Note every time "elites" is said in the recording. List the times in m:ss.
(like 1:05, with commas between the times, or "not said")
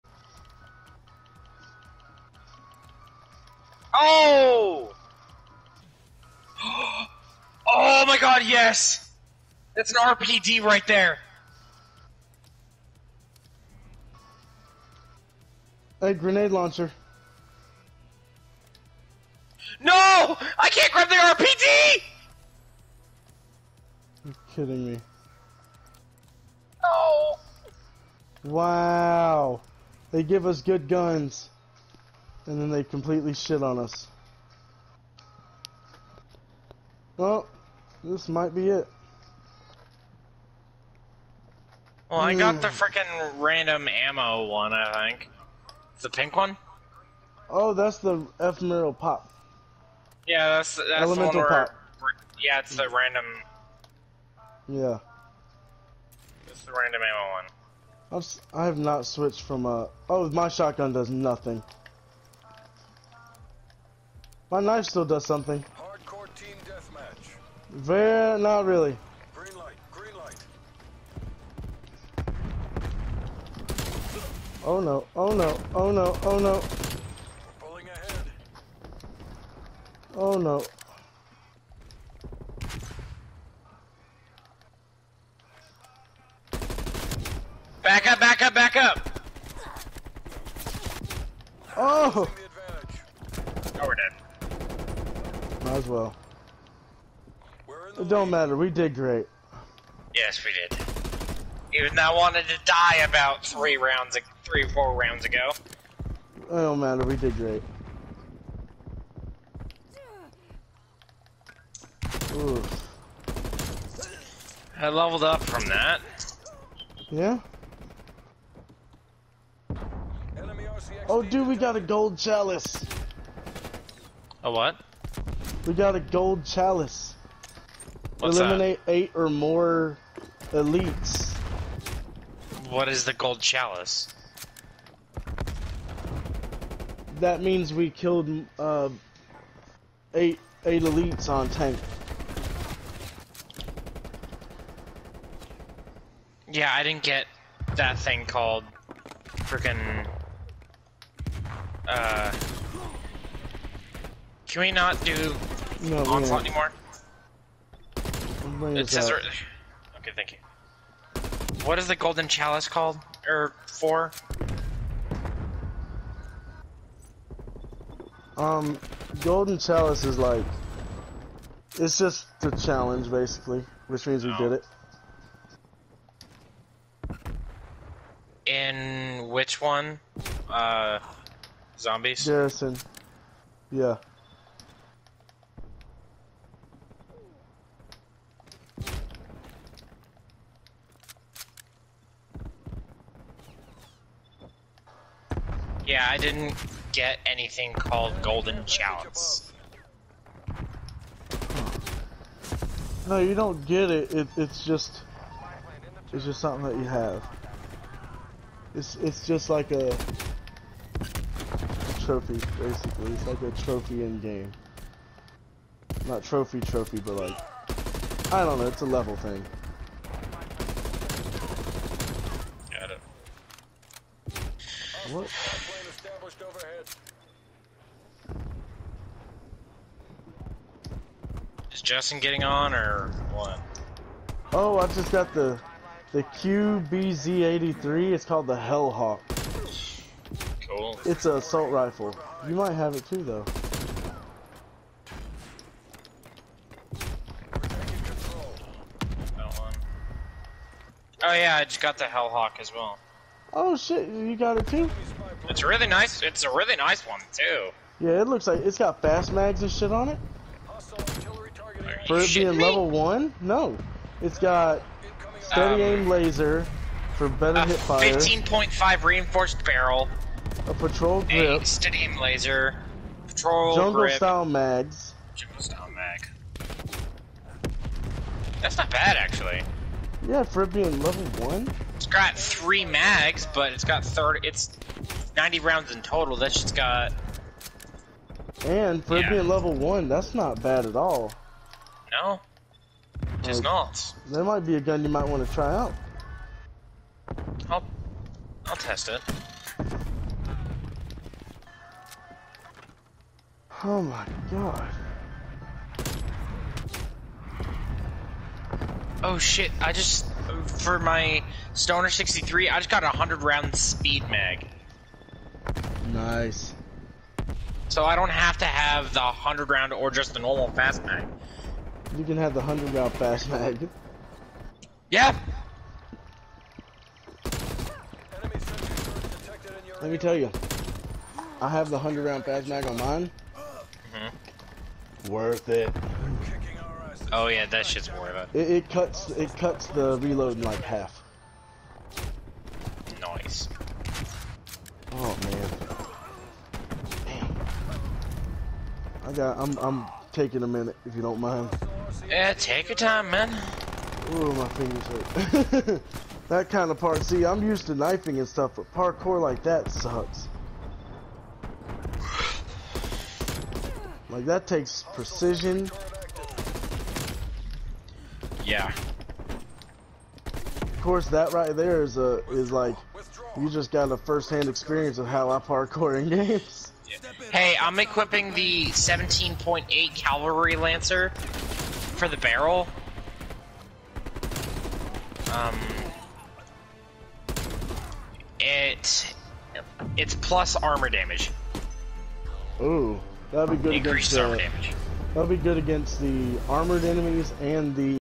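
2:10, 2:20.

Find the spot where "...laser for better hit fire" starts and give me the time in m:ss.
4:26.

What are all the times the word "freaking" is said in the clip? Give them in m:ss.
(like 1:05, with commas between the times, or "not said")
0:42, 2:29.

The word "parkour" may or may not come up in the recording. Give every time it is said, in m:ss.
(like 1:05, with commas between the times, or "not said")
5:58, 6:15.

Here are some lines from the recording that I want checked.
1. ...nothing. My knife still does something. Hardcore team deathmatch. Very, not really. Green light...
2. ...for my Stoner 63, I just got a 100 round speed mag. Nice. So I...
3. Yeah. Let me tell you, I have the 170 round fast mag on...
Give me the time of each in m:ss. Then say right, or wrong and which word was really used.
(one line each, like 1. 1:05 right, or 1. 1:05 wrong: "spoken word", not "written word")
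1. 1:01 right
2. 5:10 right
3. 5:25 wrong: "100", not "170".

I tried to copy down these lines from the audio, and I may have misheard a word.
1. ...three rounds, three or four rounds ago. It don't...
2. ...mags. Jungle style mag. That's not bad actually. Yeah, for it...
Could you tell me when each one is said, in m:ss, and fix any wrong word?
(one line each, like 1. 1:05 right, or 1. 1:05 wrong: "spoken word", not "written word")
1. 1:43 right
2. 4:34 right.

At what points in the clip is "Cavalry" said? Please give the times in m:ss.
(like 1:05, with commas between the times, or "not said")
6:20.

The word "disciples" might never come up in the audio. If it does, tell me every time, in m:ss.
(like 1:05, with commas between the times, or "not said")
not said.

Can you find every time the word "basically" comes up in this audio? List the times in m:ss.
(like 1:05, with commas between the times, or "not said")
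2:53, 3:32.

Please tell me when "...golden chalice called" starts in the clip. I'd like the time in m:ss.
2:41.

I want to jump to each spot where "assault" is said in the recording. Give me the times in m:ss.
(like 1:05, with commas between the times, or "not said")
4:01.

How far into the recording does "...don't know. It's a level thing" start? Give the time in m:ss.
3:38.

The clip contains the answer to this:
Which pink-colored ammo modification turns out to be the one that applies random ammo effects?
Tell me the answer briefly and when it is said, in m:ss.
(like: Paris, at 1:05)
Elemental Pop, at 0:48.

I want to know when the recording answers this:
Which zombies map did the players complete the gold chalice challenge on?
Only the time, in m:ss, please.
3:02.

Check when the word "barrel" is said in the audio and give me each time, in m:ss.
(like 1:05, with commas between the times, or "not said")
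4:29, 6:22.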